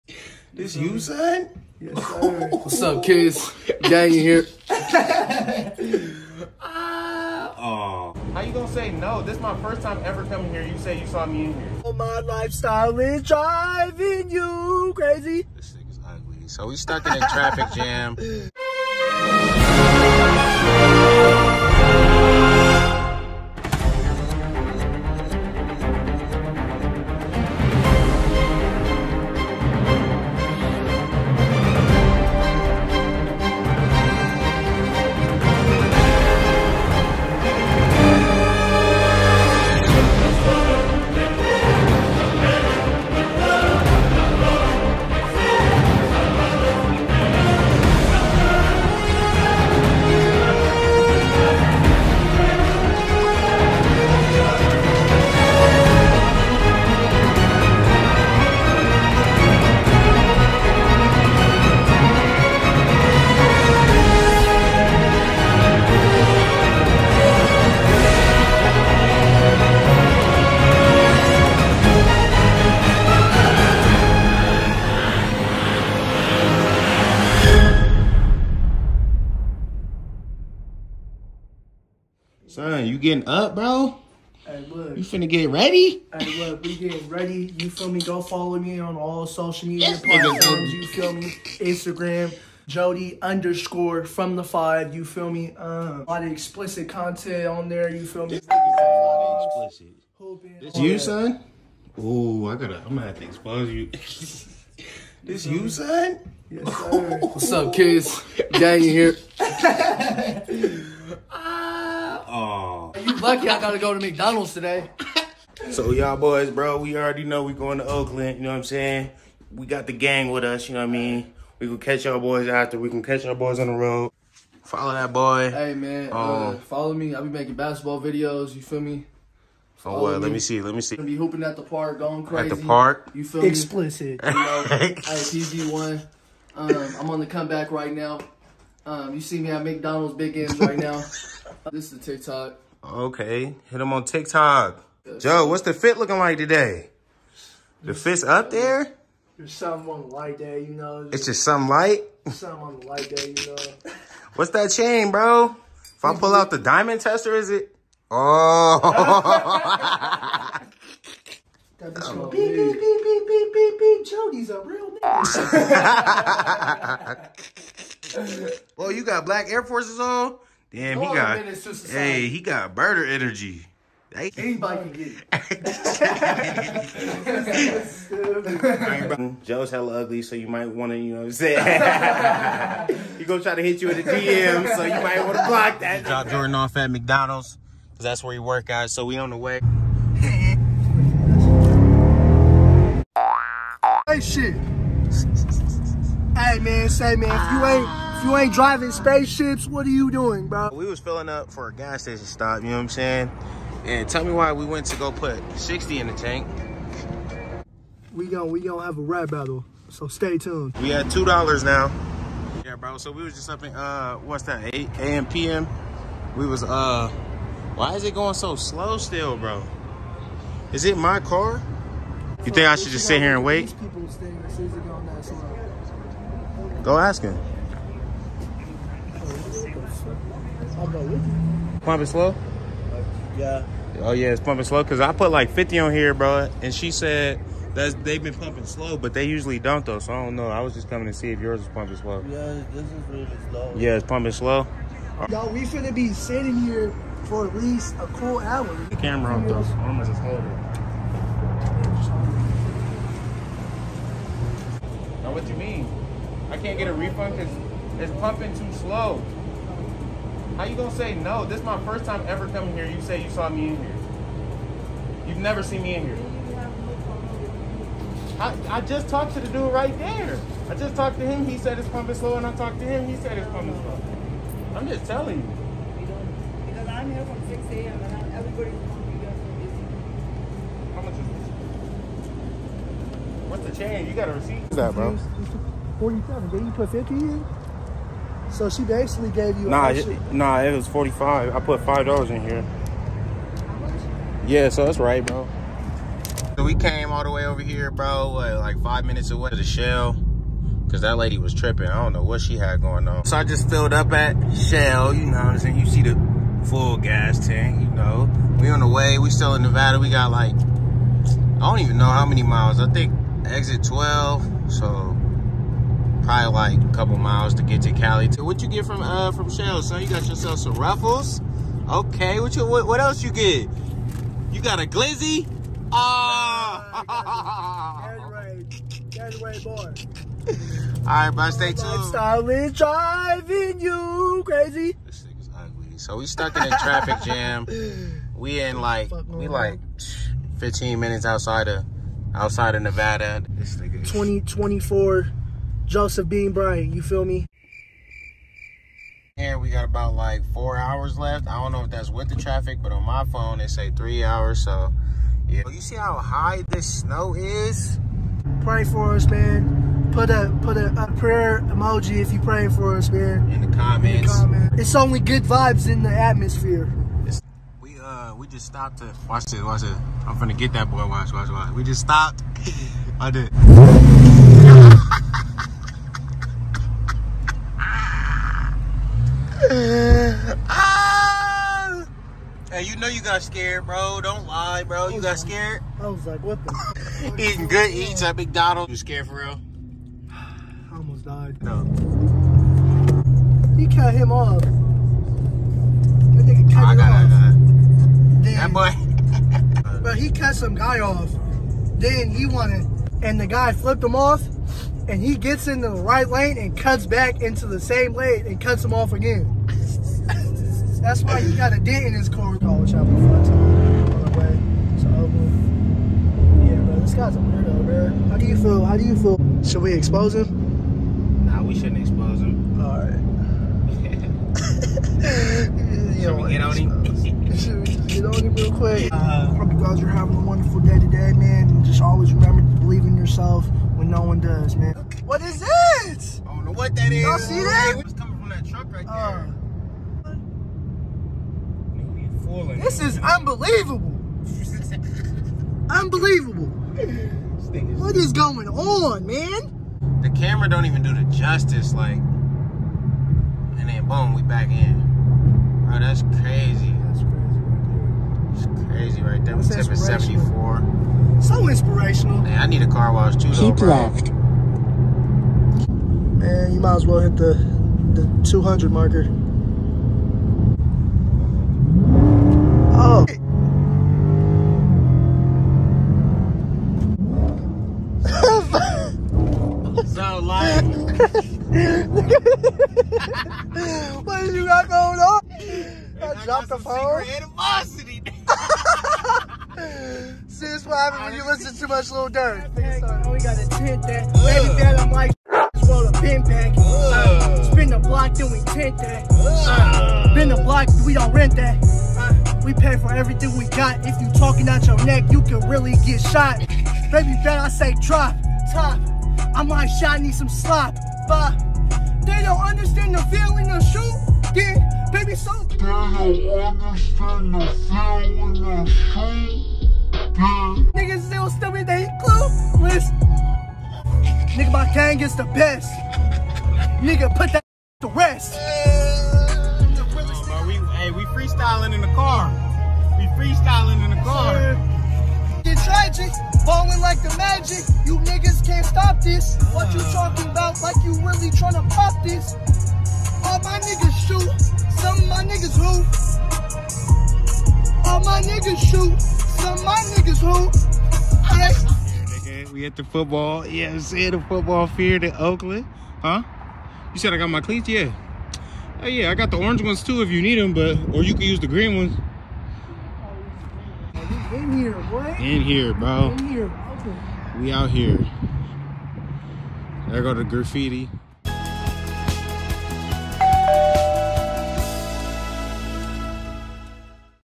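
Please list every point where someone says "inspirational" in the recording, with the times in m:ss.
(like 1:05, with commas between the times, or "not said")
7:41.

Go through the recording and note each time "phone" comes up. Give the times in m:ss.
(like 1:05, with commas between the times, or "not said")
5:53, 8:06.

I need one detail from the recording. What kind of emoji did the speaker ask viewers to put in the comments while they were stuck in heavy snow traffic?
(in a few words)
Prayer emoji.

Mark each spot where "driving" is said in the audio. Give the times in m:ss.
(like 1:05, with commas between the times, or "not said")
0:13, 3:18, 5:32.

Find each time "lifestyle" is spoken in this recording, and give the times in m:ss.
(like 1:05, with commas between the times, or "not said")
0:12, 5:31.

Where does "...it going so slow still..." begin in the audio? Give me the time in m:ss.
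3:38.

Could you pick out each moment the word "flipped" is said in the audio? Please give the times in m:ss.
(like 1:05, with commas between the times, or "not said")
6:43.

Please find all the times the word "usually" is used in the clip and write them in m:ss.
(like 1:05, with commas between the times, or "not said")
3:59.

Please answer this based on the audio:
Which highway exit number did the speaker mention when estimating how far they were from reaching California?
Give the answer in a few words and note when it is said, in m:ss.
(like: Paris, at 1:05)
12, at 5:13.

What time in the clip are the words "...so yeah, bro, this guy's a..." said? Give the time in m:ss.
6:55.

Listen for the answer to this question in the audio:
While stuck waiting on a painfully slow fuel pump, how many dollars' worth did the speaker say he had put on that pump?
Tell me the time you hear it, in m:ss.
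3:54.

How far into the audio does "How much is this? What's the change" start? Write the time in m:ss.
4:40.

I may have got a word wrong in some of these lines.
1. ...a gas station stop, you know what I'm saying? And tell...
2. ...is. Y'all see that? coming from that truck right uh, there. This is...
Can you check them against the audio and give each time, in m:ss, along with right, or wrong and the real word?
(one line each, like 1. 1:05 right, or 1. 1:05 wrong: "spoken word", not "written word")
1. 3:21 right
2. 7:17 right.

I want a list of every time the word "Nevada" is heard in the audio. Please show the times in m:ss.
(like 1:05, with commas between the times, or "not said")
5:09, 5:42.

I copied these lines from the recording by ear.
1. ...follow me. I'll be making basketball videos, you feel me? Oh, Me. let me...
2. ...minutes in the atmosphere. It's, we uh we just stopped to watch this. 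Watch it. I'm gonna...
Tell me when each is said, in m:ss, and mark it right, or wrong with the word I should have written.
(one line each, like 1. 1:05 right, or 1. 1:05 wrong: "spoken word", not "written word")
1. 2:06 right
2. 6:05 wrong: "vibes", not "minutes".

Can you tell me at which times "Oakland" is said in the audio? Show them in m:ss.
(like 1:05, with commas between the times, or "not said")
1:57, 9:15.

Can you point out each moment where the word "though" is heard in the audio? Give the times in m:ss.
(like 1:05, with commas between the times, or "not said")
3:59, 4:09, 7:43.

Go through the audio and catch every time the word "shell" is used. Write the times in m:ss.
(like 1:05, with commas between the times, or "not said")
4:59, 5:04, 5:19.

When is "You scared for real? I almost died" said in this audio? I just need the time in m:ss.
6:28.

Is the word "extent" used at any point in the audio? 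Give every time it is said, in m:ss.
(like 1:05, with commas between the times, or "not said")
not said.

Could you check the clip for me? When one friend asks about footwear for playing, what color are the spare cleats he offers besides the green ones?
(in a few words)
Orange.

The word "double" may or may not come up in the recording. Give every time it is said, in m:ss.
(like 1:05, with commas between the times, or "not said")
not said.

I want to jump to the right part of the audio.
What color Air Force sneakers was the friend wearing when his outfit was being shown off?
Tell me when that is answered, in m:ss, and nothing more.
2:49.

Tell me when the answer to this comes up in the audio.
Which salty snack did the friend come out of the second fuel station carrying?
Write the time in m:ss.
5:20.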